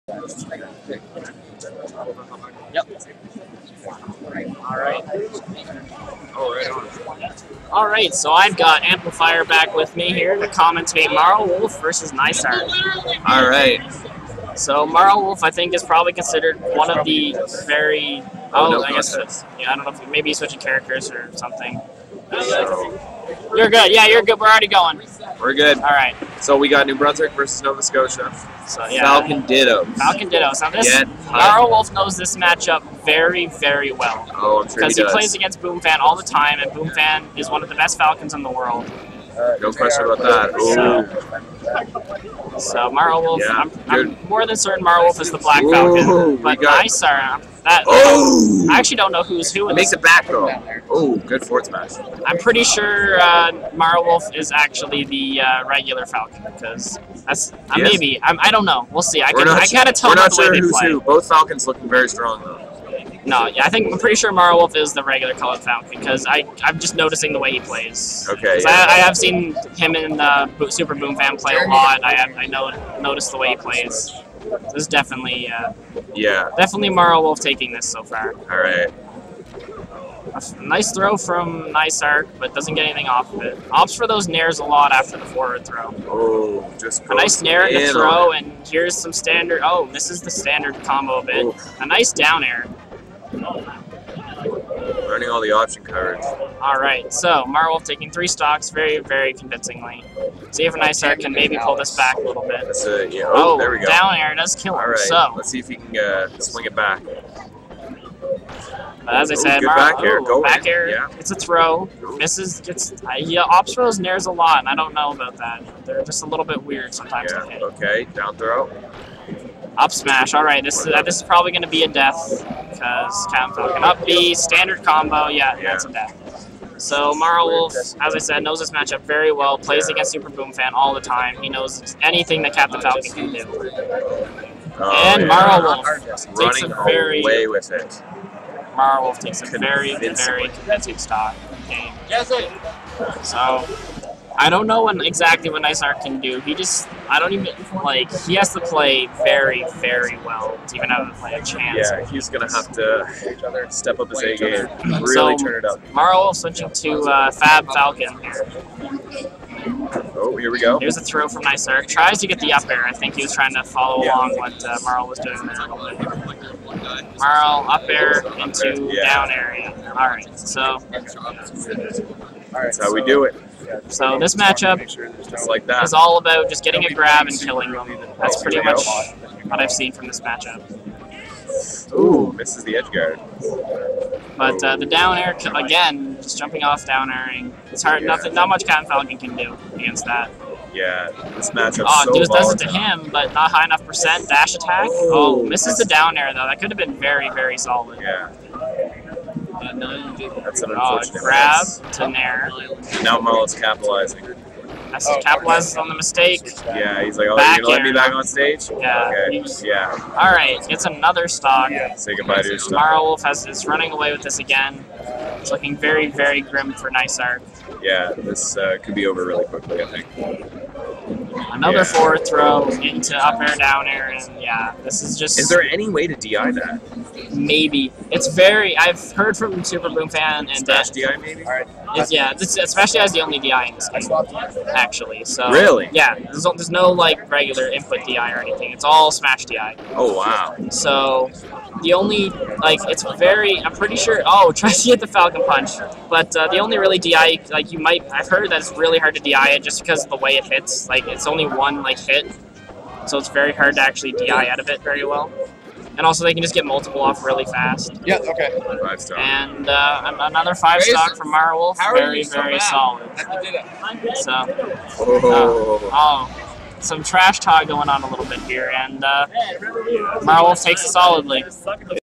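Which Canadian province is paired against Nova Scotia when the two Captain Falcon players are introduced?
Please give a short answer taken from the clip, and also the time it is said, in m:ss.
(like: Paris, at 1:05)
New Brunswick, at 0:26.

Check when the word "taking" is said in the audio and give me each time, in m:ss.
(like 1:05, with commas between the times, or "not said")
1:17, 1:37.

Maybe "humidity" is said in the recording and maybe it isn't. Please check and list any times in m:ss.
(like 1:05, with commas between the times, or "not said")
not said.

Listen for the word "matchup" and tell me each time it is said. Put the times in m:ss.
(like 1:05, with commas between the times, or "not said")
0:32, 2:08, 2:54, 3:00, 3:11.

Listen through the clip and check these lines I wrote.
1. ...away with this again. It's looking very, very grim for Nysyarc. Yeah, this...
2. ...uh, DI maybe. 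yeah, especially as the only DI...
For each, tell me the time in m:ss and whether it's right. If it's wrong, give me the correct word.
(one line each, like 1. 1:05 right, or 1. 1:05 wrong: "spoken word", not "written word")
1. 3:33 right
2. 3:50 right.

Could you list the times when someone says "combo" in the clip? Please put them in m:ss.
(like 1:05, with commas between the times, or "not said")
1:30, 2:04.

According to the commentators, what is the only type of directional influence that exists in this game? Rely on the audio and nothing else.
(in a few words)
Smash DI.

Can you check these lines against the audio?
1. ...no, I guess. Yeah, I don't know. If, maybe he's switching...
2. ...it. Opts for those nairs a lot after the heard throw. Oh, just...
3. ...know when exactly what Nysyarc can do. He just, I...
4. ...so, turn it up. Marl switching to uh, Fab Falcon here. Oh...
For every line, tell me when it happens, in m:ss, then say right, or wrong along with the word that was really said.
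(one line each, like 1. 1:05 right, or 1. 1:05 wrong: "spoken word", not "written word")
1. 0:18 right
2. 1:23 wrong: "forward", not "heard"
3. 2:24 right
4. 2:35 right.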